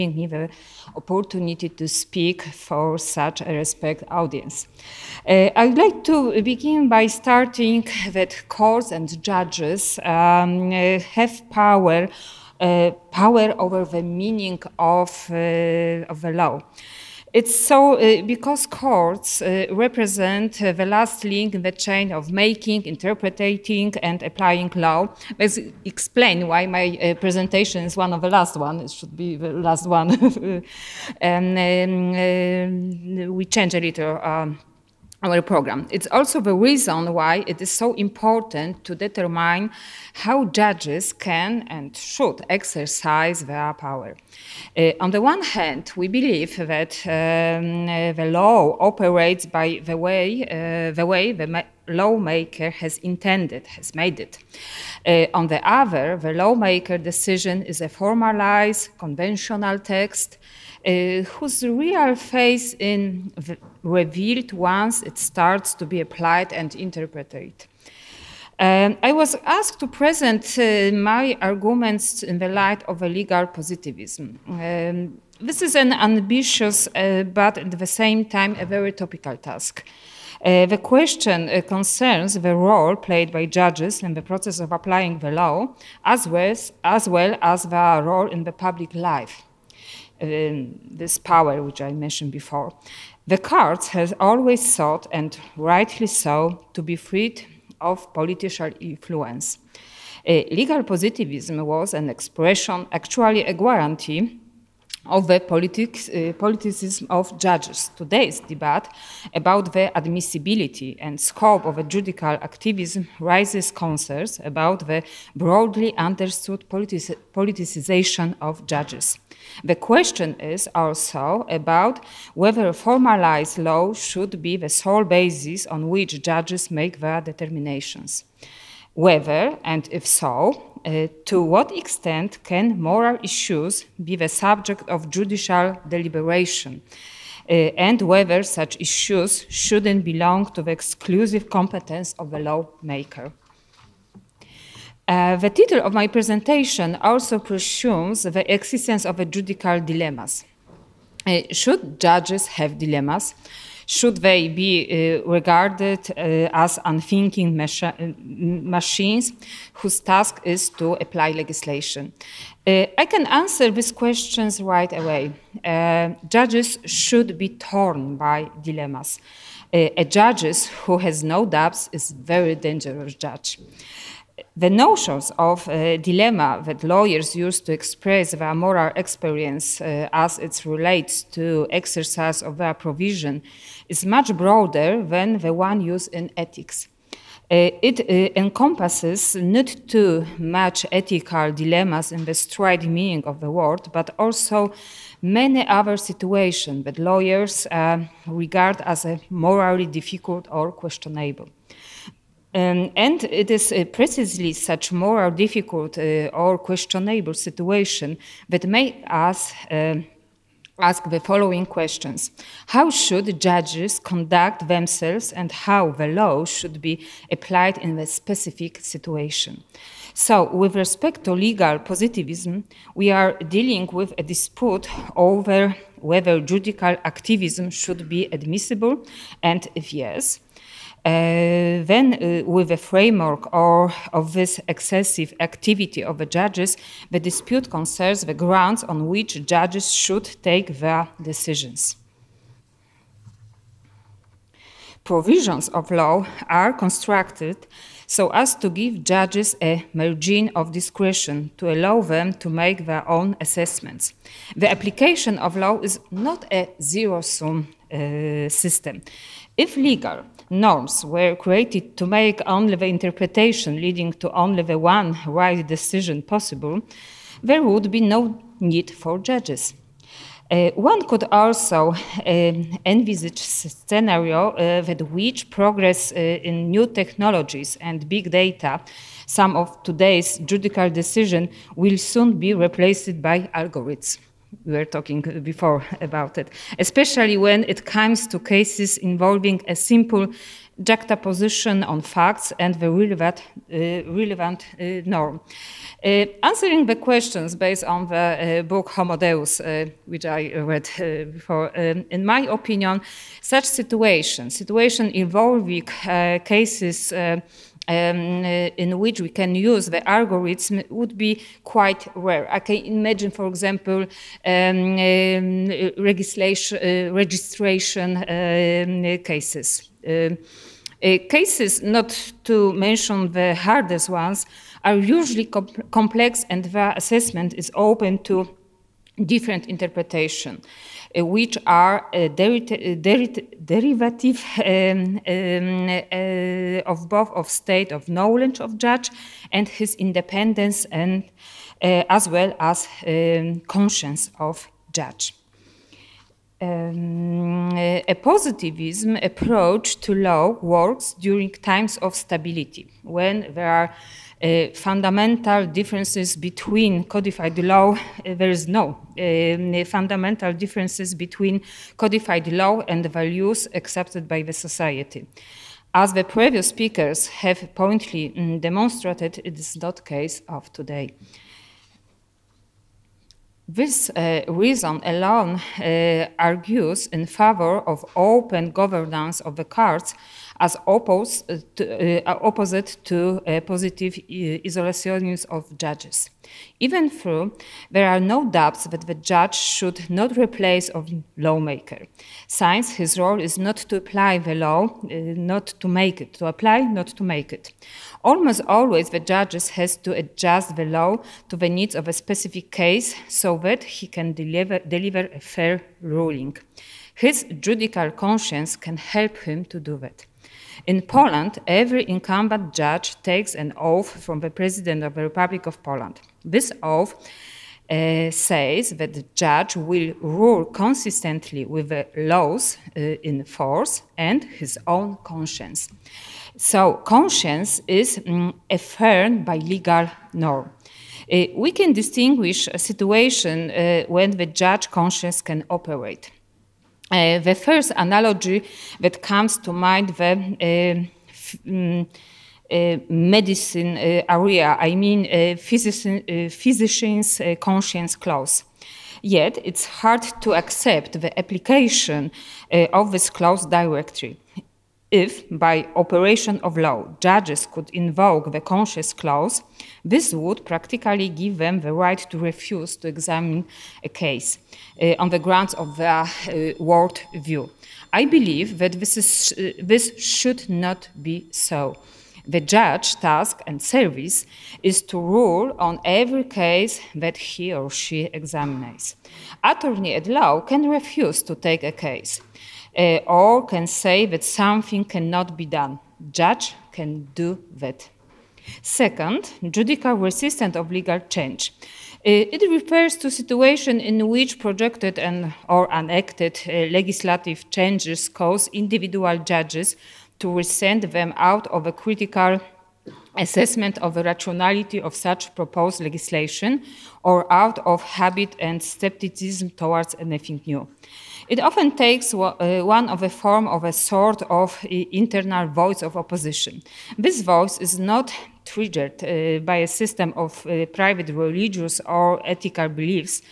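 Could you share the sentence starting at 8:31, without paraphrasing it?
It often takes uh, one of the form of a sort of uh, internal voice of opposition.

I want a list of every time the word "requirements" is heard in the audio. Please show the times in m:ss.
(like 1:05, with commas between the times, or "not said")
not said.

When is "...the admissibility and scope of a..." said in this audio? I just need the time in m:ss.
1:49.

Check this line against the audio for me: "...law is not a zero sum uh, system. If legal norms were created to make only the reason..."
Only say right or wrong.
wrong.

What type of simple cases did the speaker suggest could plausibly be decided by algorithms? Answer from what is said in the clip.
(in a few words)
registration cases.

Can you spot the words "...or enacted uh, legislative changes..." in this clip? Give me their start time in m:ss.
8:15.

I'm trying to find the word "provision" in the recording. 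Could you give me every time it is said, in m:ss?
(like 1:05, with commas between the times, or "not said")
3:02, 4:05.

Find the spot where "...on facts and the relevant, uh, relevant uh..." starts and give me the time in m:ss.
4:51.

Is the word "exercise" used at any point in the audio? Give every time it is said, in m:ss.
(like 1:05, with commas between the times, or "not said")
0:42, 3:01.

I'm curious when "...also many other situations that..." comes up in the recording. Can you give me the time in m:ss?
3:14.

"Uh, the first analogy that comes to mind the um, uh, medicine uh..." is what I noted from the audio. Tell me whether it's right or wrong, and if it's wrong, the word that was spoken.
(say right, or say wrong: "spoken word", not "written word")
right.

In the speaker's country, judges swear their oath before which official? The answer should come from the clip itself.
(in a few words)
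President of the Republic of Poland.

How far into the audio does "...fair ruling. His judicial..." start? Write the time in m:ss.
6:45.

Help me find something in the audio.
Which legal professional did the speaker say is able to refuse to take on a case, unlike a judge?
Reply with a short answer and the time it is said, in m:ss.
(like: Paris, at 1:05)
Attorney at law, at 7:59.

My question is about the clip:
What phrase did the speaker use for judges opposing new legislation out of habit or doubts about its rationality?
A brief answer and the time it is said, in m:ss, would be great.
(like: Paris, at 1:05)
judicial resistance, at 8:09.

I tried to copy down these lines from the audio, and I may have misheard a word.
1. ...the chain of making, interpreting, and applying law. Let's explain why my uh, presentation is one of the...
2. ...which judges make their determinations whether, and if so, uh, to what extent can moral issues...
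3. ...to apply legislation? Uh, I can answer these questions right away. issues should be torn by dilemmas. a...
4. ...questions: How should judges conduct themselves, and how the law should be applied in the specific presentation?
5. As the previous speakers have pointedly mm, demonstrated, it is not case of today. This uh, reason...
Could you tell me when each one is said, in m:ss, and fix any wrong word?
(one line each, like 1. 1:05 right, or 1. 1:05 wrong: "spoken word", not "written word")
1. 0:21 right
2. 2:05 right
3. 2:40 wrong: "judges", not "issues"
4. 3:31 wrong: "situation", not "presentation"
5. 6:05 right.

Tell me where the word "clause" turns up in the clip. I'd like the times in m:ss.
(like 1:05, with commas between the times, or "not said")
7:28, 7:33, 7:39.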